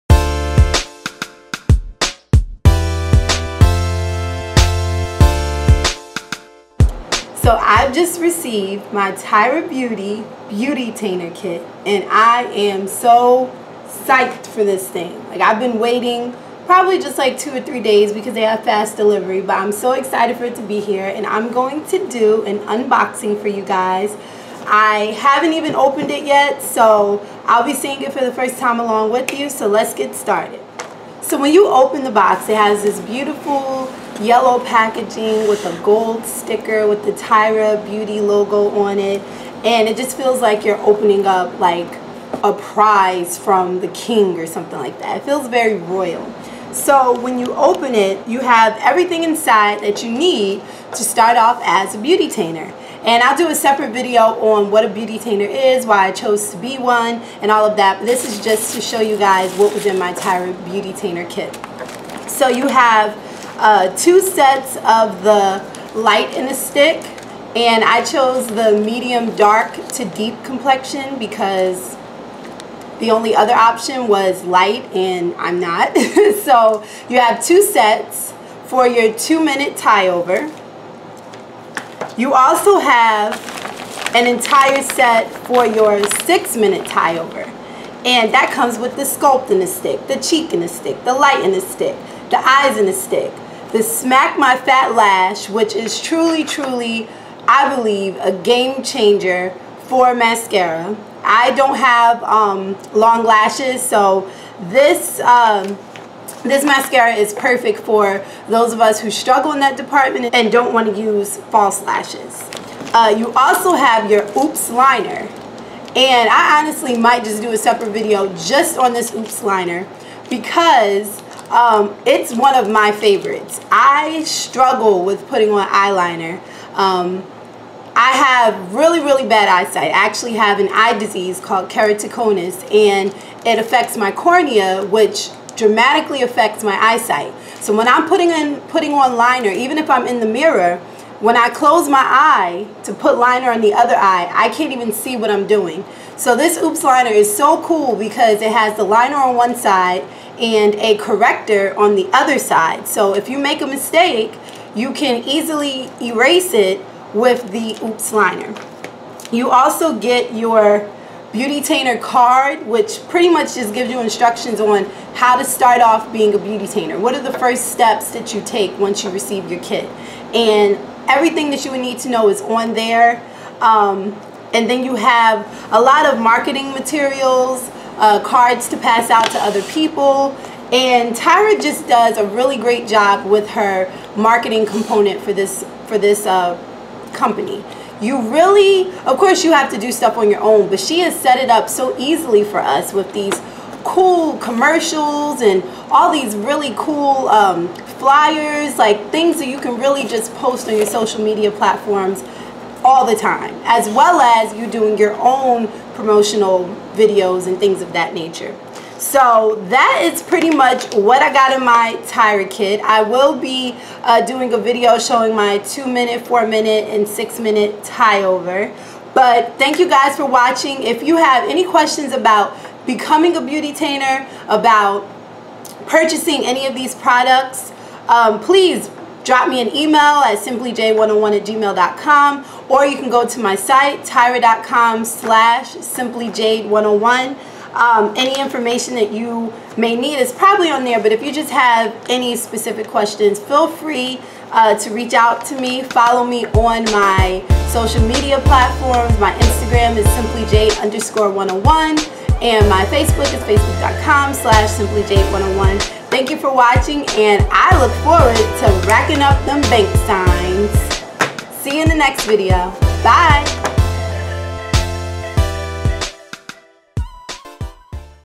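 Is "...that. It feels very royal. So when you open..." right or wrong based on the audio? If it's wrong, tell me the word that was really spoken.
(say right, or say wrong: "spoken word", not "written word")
right.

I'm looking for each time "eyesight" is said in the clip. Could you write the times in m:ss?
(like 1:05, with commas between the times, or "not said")
2:09, 2:16.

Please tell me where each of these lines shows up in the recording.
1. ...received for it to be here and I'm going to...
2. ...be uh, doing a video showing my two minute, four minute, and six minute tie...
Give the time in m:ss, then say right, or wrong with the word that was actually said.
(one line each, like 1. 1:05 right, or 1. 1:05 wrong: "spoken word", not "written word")
1. 0:19 wrong: "excited", not "received"
2. 3:33 right.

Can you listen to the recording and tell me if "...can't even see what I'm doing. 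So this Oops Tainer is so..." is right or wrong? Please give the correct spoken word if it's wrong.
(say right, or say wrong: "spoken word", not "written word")
wrong: "Liner", not "Tainer".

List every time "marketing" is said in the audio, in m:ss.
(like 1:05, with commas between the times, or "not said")
2:56, 3:04.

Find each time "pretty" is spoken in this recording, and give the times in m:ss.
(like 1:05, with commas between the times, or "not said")
2:43, 3:30.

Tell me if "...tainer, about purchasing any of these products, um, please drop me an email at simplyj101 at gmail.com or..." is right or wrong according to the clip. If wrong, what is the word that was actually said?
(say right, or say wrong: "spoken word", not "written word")
right.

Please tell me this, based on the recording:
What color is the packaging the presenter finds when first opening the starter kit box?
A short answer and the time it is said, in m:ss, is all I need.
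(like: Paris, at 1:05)
Yellow, at 0:34.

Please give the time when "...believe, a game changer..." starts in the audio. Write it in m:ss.
1:37.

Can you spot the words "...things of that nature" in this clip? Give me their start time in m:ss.
3:27.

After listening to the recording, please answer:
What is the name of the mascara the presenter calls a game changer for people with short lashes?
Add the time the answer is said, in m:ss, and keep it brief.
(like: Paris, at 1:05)
Smack My Fat Lash, at 1:33.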